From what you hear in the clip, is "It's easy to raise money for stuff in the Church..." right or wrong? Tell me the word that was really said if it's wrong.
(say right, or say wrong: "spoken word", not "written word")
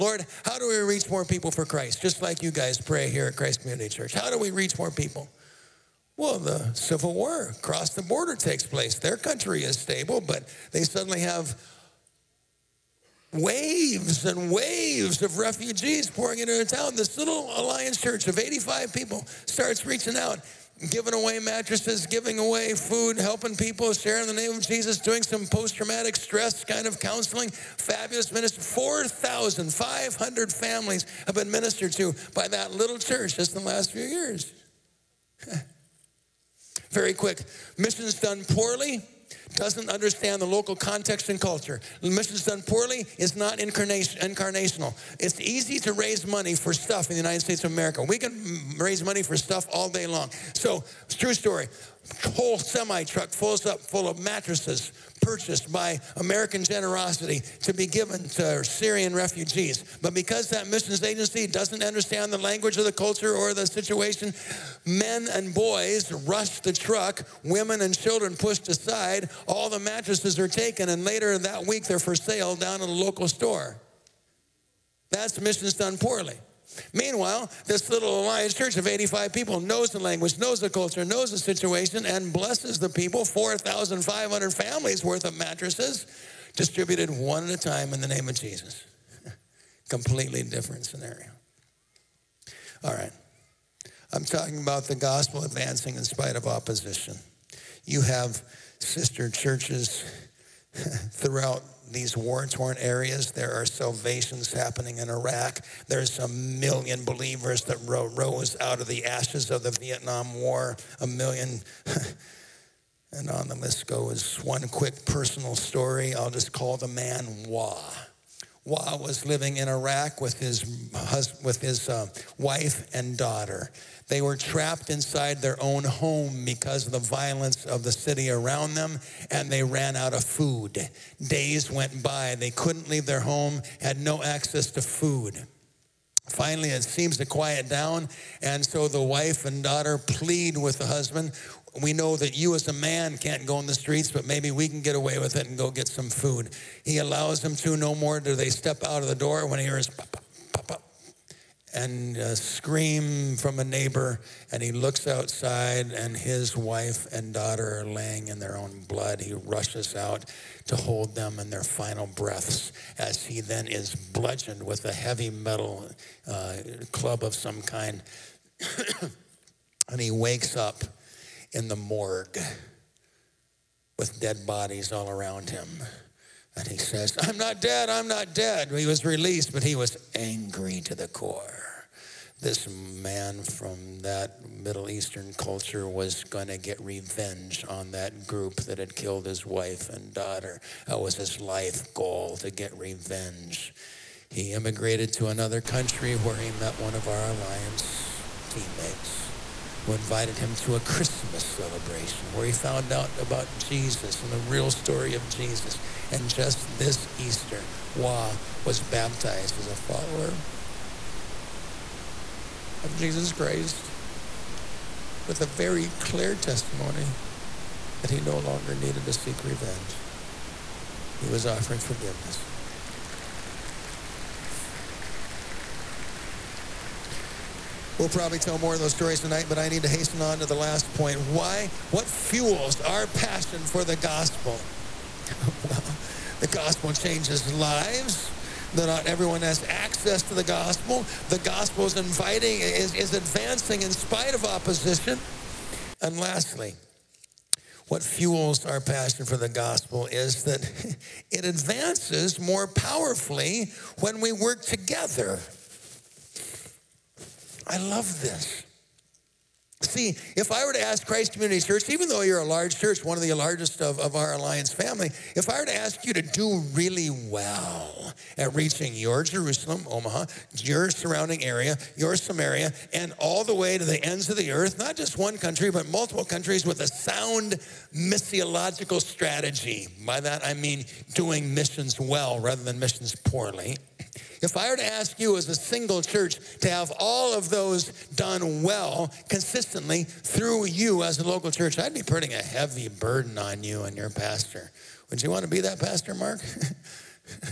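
wrong: "United", not "Church".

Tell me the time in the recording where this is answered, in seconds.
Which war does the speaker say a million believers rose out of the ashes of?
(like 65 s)
109 s.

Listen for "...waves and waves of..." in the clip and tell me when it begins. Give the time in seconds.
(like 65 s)
13 s.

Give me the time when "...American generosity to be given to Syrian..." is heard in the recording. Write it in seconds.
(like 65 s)
56 s.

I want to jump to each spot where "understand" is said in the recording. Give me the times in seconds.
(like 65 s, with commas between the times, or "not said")
39 s, 61 s.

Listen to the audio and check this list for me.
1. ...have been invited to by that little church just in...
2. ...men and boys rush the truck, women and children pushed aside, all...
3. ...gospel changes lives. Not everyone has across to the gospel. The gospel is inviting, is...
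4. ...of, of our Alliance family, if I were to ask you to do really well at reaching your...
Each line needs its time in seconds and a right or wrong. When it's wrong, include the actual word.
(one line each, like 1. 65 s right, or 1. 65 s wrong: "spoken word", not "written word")
1. 31 s wrong: "ministered", not "invited"
2. 64 s right
3. 236 s wrong: "access", not "across"
4. 263 s right.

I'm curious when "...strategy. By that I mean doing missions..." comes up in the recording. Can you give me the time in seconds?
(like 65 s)
279 s.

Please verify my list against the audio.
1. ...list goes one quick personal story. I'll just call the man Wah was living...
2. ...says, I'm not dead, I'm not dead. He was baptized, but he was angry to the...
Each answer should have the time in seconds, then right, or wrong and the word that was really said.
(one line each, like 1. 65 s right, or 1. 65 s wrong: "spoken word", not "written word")
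1. 113 s right
2. 176 s wrong: "released", not "baptized".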